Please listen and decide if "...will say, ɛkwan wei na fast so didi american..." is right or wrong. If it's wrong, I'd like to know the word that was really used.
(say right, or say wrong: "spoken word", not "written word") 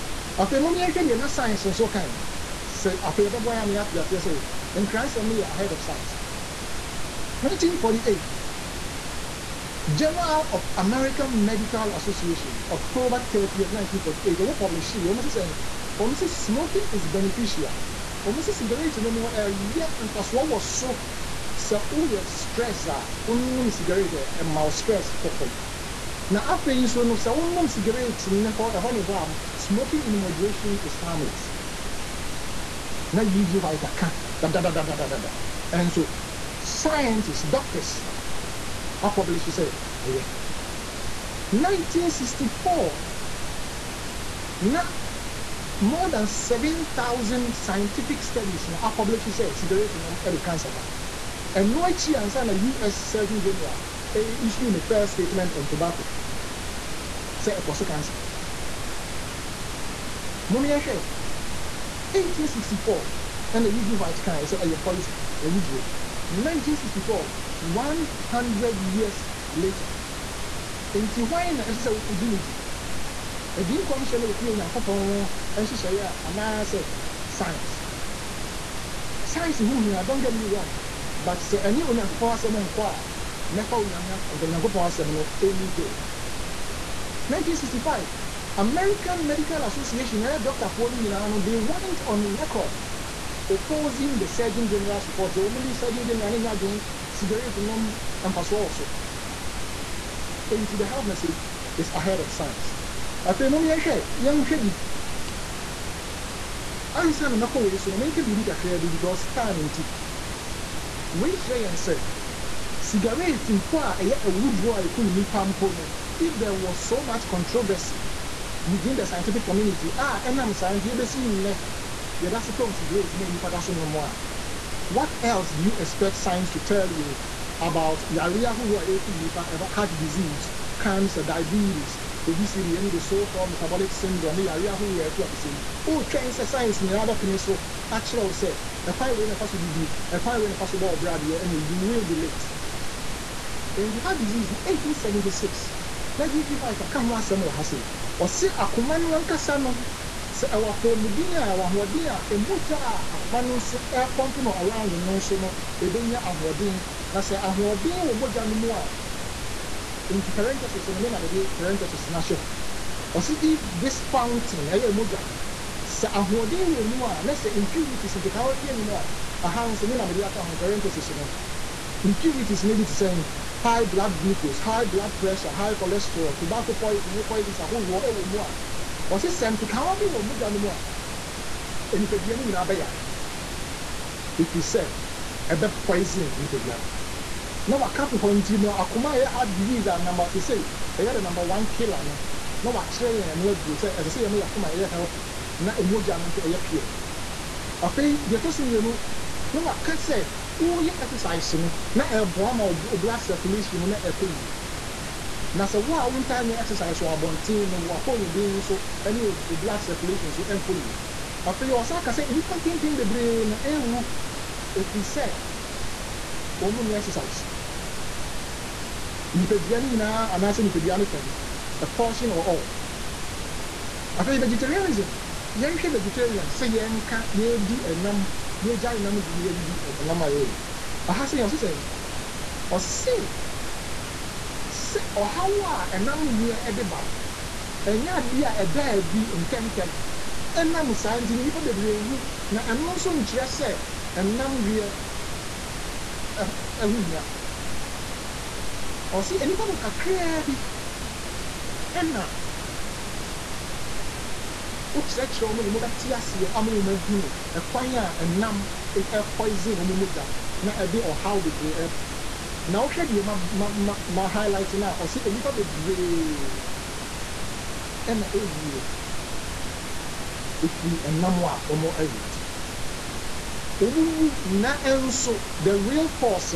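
wrong: "ɛkwan", not "american".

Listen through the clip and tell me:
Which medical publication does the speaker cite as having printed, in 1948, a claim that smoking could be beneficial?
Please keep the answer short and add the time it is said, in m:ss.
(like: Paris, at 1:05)
Journal of American Medical Association, at 0:09.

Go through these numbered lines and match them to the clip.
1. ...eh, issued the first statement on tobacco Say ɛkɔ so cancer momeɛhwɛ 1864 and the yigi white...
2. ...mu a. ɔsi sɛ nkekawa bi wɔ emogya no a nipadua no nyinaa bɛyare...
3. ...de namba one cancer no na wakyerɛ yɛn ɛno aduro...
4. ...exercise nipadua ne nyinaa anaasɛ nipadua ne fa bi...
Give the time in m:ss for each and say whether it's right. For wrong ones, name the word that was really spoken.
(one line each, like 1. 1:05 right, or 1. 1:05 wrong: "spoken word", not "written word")
1. 0:54 right
2. 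2:58 wrong: "mogya", not "emogya"
3. 3:11 wrong: "killer", not "cancer"
4. 3:36 right.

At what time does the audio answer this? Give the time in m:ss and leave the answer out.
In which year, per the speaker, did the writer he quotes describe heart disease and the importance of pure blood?
2:24.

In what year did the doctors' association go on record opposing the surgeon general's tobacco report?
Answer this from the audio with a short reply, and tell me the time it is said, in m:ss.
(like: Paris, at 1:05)
1965, at 1:27.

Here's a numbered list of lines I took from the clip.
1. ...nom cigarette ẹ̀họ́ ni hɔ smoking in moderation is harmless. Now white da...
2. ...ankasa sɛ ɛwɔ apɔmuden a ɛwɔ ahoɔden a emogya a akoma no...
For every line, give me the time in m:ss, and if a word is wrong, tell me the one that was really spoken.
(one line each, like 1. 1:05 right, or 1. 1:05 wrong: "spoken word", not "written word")
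1. 0:27 right
2. 2:29 right.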